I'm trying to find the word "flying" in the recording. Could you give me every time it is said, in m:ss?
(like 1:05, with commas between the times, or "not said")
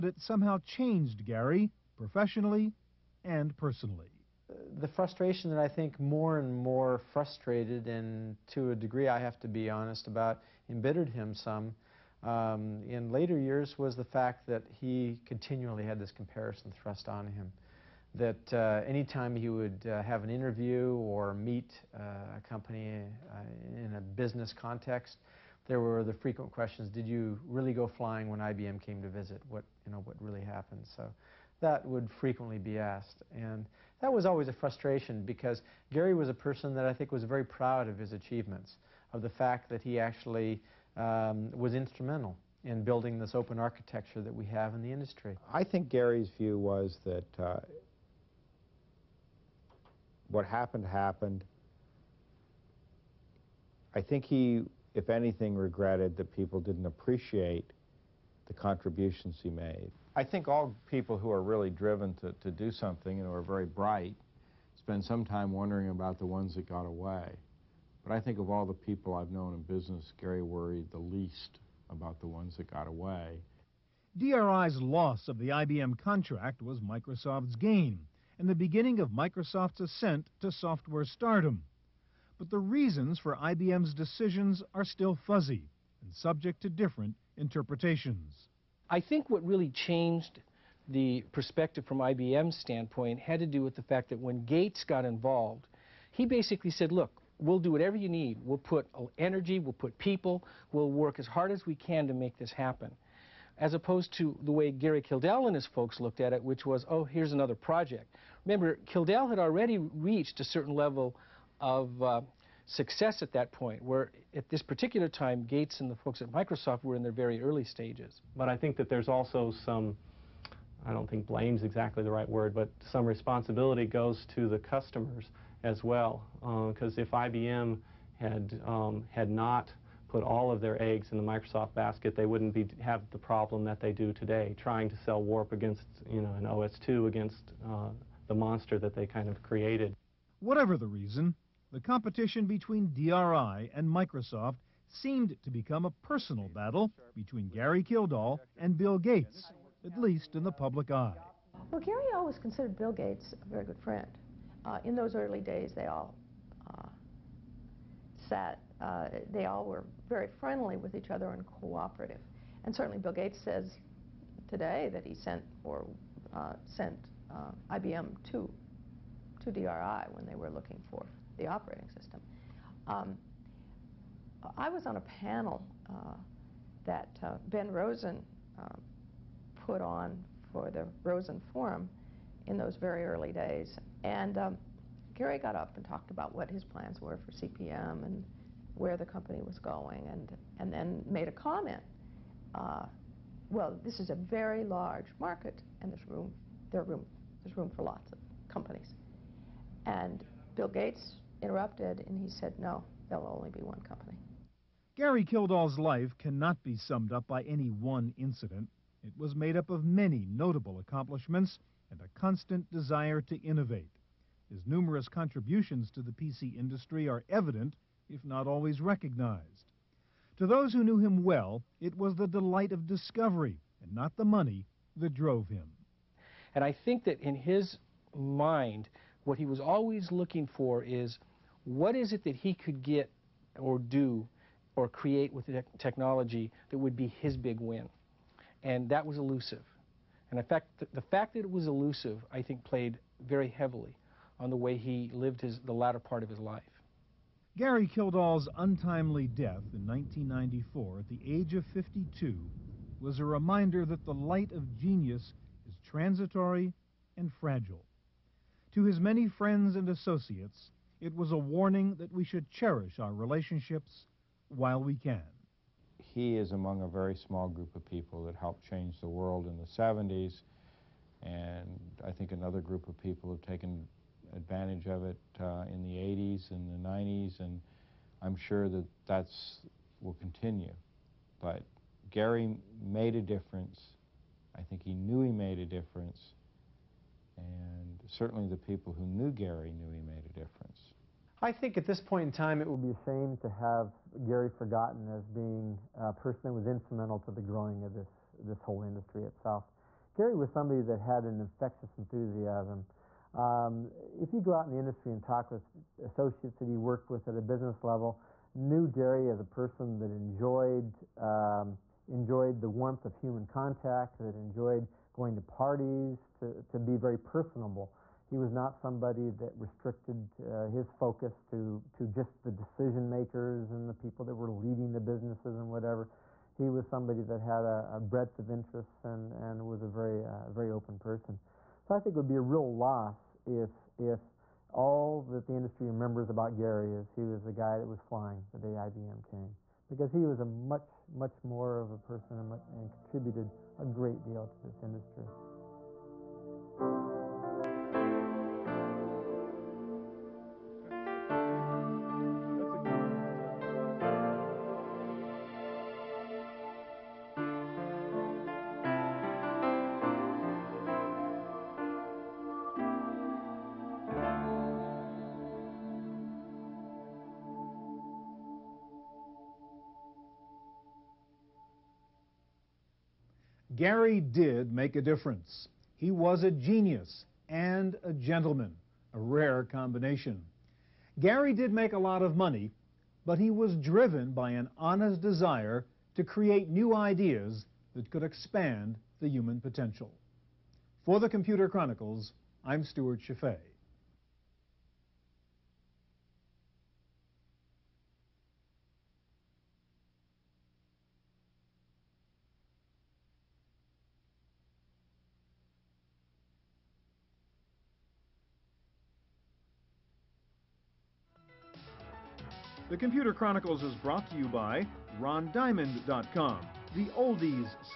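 0:27, 5:38.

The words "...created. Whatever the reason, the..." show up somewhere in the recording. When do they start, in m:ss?
2:19.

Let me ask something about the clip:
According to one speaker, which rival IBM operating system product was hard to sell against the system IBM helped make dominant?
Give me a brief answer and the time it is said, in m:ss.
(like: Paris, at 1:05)
Warp, at 2:15.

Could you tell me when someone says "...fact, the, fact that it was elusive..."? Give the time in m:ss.
4:00.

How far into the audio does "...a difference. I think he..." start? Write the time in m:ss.
4:43.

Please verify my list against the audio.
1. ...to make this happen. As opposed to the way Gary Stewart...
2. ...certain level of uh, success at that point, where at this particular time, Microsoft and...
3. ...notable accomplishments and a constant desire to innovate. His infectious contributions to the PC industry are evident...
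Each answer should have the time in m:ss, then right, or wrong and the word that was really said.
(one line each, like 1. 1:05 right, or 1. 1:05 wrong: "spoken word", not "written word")
1. 1:42 wrong: "Kildall", not "Stewart"
2. 1:50 wrong: "Gates", not "Microsoft"
3. 3:30 wrong: "numerous", not "infectious".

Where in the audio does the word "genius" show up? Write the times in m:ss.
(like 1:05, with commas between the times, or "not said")
4:14, 6:16.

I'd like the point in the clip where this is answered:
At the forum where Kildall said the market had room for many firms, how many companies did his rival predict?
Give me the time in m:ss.
3:23.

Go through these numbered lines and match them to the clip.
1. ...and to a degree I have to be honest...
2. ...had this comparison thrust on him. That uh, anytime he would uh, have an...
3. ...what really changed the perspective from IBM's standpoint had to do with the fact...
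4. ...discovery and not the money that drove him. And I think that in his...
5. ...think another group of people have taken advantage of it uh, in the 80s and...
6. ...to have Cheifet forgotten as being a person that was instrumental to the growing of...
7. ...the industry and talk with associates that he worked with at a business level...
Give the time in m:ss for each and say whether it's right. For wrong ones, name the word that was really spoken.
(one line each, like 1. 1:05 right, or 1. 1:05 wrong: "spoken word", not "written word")
1. 0:07 right
2. 0:15 right
3. 1:29 right
4. 3:42 right
5. 4:32 right
6. 4:53 wrong: "Gary", not "Cheifet"
7. 5:04 right.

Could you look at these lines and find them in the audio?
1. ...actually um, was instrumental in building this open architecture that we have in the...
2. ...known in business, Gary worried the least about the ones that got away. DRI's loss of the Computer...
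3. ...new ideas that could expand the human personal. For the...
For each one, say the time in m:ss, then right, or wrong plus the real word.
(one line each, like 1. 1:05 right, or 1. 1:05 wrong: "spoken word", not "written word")
1. 0:39 right
2. 1:09 wrong: "IBM", not "Computer"
3. 6:26 wrong: "potential", not "personal".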